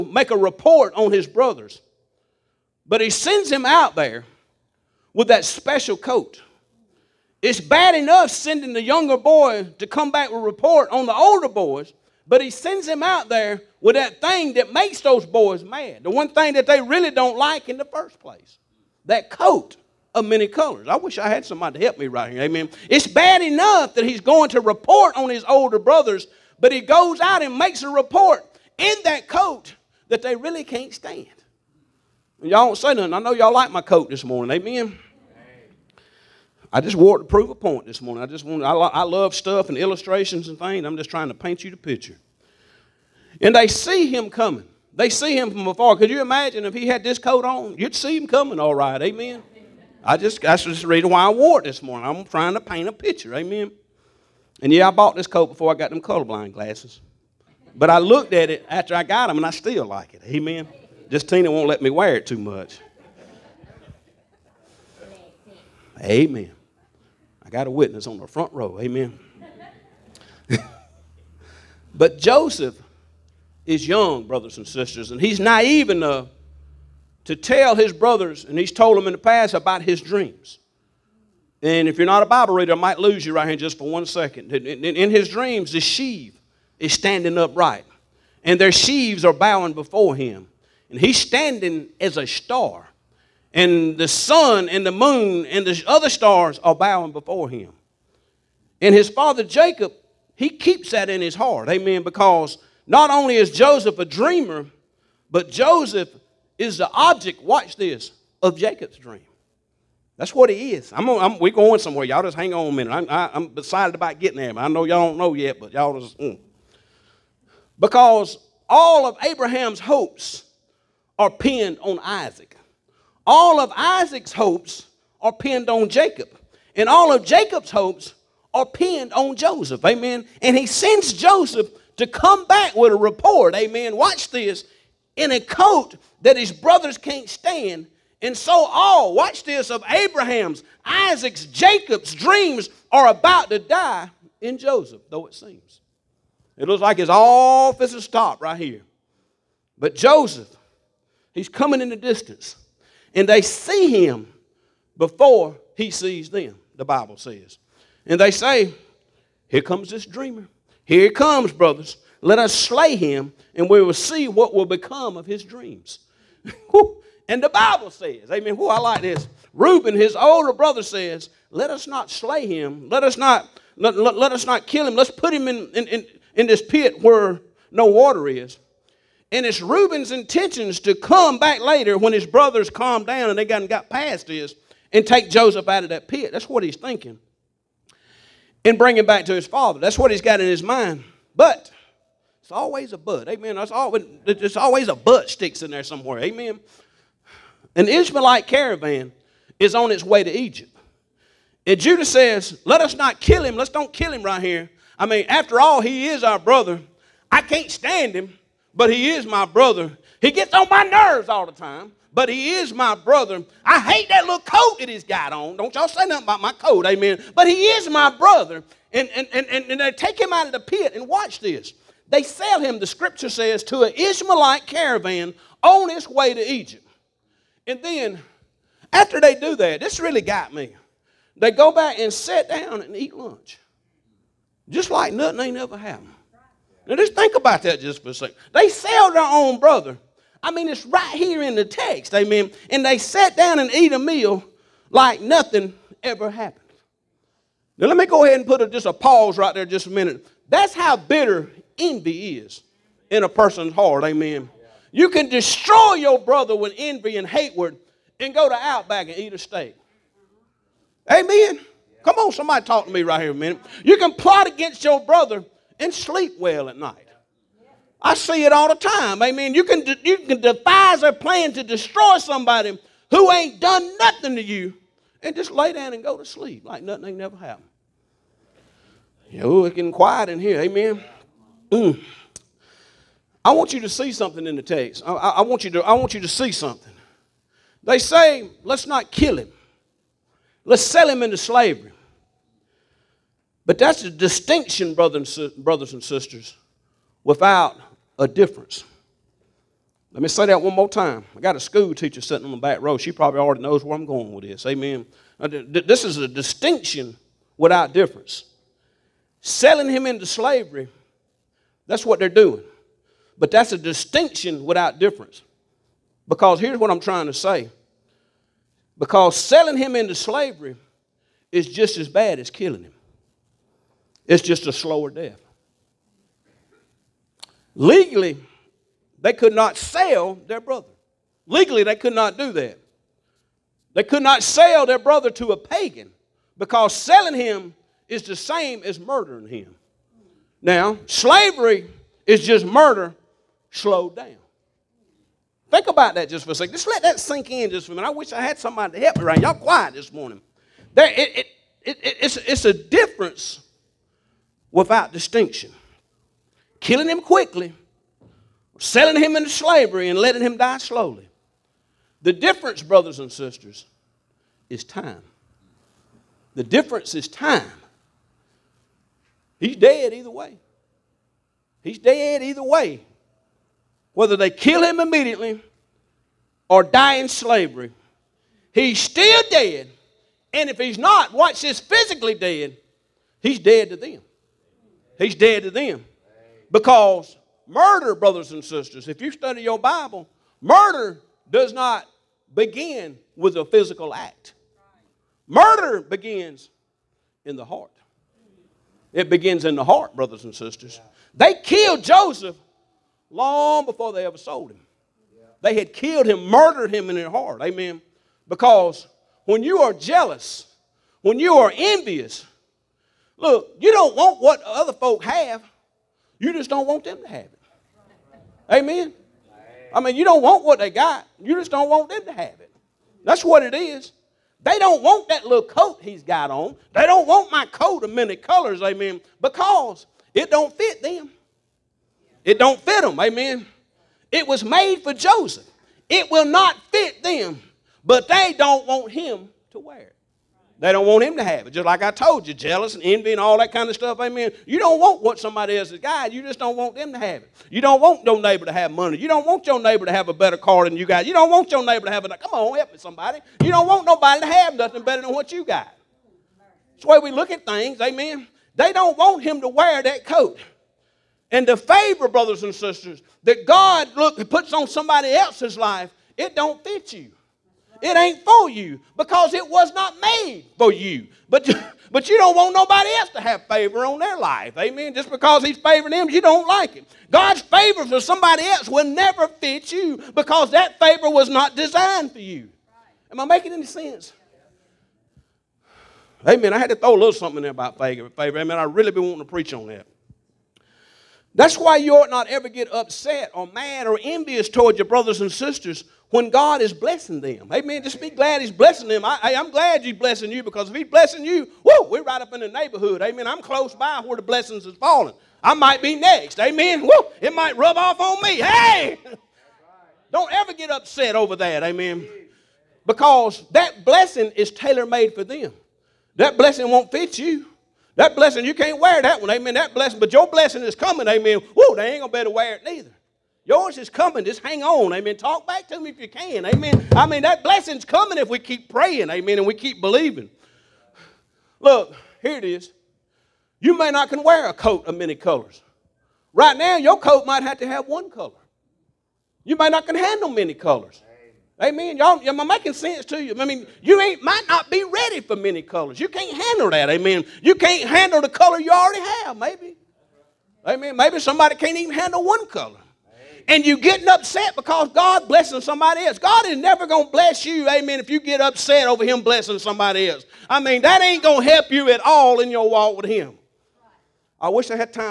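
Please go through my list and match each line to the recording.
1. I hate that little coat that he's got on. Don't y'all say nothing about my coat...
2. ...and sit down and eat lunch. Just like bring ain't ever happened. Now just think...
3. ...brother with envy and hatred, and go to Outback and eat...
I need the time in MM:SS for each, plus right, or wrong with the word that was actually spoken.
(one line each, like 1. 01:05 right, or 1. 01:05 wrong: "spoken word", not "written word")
1. 03:33 right
2. 03:51 wrong: "nothing", not "bring"
3. 04:16 right.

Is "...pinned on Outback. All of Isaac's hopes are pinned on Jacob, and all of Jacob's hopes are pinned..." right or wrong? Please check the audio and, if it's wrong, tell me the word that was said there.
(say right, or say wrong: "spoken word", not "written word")
wrong: "Isaac", not "Outback".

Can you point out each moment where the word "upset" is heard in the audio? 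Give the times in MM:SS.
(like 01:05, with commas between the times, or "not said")
08:12, 08:30, 09:14, 09:18.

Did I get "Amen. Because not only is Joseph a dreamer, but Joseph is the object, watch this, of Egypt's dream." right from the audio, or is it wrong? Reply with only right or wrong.
wrong.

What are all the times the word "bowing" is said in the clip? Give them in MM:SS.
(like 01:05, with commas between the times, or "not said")
01:29, 01:36.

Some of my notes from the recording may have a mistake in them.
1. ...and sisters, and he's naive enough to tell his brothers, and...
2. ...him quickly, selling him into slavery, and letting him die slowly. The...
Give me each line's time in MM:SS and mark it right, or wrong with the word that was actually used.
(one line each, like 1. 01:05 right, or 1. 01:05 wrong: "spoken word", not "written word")
1. 01:14 right
2. 05:57 right.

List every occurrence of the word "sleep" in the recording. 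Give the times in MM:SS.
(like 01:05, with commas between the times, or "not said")
04:25, 04:36.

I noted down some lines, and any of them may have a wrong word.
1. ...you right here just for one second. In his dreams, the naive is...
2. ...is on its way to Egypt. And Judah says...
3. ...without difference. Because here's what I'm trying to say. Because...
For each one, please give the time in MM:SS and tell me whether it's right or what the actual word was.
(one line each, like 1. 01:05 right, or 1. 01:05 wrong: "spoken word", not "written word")
1. 01:23 wrong: "sheave", not "naive"
2. 03:19 right
3. 05:14 right.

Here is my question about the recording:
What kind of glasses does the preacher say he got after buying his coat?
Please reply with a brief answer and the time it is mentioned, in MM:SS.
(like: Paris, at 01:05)
colorblind glasses, at 00:56.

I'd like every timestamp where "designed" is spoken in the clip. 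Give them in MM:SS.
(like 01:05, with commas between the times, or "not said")
08:01.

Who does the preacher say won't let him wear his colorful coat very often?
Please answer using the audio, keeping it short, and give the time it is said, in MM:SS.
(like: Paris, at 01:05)
Tina, at 01:01.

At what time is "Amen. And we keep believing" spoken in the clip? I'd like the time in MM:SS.
08:49.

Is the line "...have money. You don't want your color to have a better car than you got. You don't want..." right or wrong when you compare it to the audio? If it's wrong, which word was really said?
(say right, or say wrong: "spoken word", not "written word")
wrong: "neighbor", not "color".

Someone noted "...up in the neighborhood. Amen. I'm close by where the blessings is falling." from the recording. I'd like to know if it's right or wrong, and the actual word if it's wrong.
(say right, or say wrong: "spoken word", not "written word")
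right.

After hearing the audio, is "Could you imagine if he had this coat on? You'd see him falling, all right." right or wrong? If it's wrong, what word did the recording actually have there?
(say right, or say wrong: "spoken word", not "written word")
wrong: "coming", not "falling".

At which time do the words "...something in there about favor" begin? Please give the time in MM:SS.
08:07.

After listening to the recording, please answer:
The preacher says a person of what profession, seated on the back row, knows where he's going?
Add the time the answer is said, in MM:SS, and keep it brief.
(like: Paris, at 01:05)
school teacher, at 05:01.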